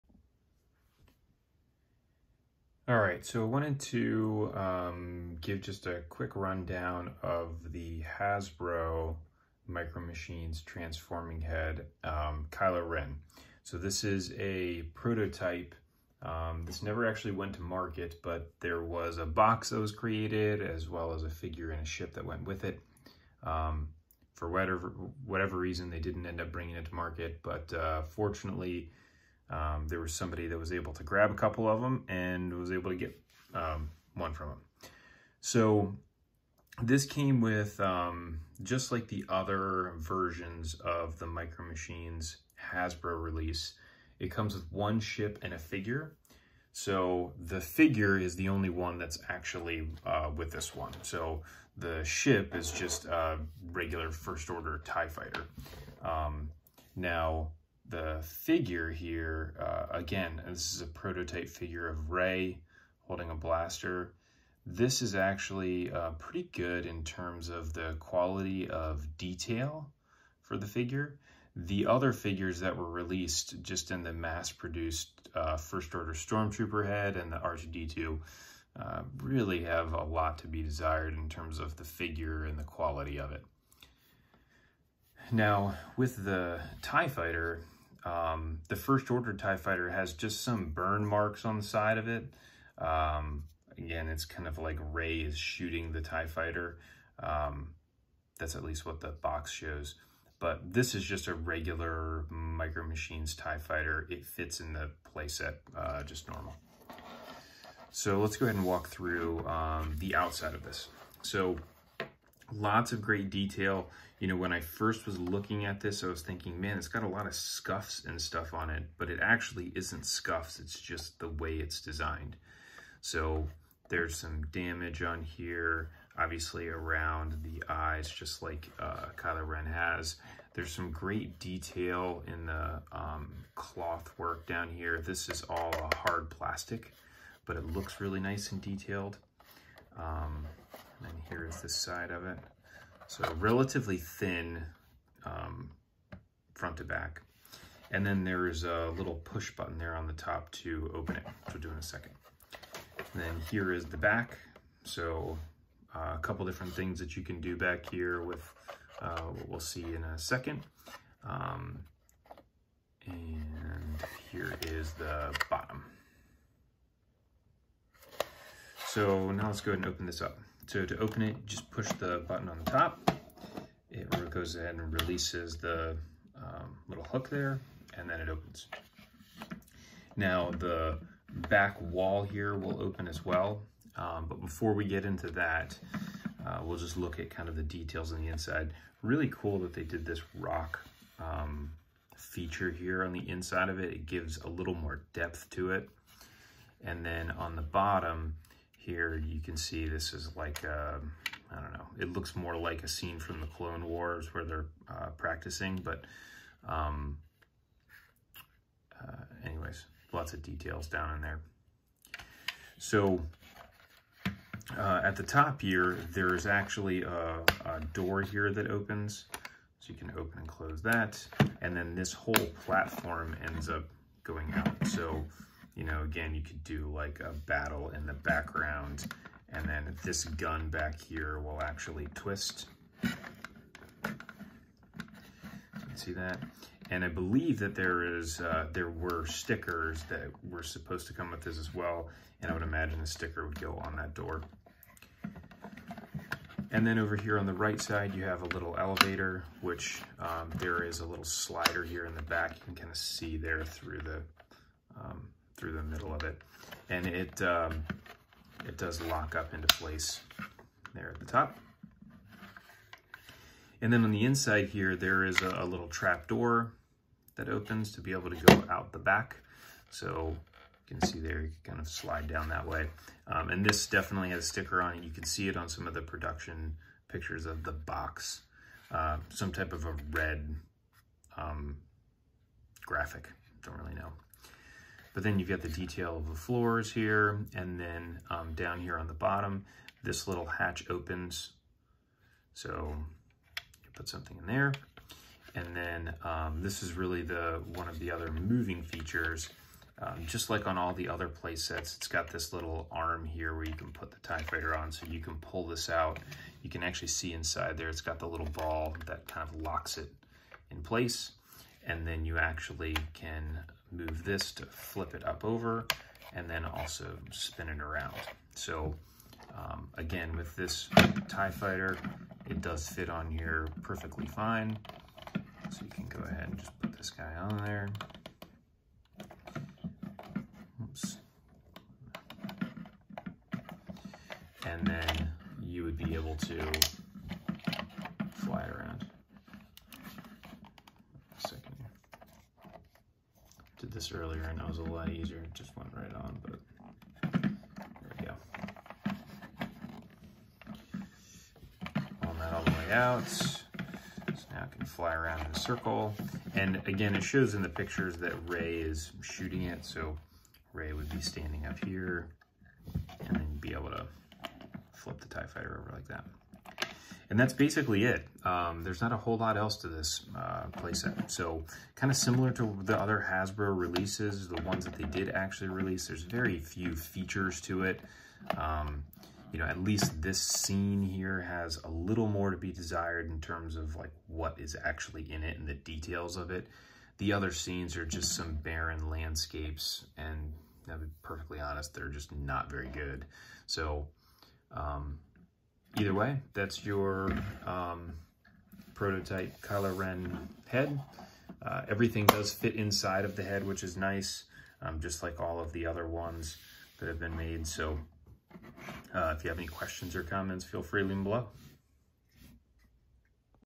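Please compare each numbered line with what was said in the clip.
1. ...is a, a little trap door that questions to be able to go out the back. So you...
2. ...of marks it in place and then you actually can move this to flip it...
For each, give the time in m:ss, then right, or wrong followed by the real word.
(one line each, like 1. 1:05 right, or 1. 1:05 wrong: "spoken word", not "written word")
1. 4:25 wrong: "opens", not "questions"
2. 5:09 wrong: "locks", not "marks".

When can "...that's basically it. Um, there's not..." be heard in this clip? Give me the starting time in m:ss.
6:07.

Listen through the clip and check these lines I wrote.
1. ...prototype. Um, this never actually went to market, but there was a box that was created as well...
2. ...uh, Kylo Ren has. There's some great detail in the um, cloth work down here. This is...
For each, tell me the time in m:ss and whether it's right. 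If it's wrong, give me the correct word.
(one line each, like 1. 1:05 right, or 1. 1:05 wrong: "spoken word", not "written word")
1. 0:14 right
2. 2:08 right.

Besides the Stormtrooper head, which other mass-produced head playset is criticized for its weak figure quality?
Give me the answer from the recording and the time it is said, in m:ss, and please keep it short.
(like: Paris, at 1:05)
R2-D2, at 1:17.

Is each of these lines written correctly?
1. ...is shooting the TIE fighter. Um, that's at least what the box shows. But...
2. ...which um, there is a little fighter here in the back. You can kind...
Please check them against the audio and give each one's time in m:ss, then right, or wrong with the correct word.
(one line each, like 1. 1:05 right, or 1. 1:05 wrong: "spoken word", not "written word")
1. 1:35 right
2. 4:09 wrong: "slider", not "fighter".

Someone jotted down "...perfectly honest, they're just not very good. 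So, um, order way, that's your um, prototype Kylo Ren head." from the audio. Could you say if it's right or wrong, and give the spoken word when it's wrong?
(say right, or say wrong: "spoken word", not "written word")
wrong: "either", not "order".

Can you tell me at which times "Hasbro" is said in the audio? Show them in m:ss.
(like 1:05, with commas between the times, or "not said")
0:08, 0:42, 6:13.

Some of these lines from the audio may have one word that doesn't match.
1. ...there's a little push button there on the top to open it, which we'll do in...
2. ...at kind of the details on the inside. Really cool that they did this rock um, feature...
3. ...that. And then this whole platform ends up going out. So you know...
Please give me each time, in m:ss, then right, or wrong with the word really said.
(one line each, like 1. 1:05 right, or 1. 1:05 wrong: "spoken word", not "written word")
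1. 2:28 right
2. 3:07 right
3. 3:40 right.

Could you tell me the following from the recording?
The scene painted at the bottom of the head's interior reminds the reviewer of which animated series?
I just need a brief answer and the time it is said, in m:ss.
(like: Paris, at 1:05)
the Clone Wars, at 3:23.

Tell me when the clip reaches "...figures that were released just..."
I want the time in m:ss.
1:12.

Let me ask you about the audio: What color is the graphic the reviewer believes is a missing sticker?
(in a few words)
red.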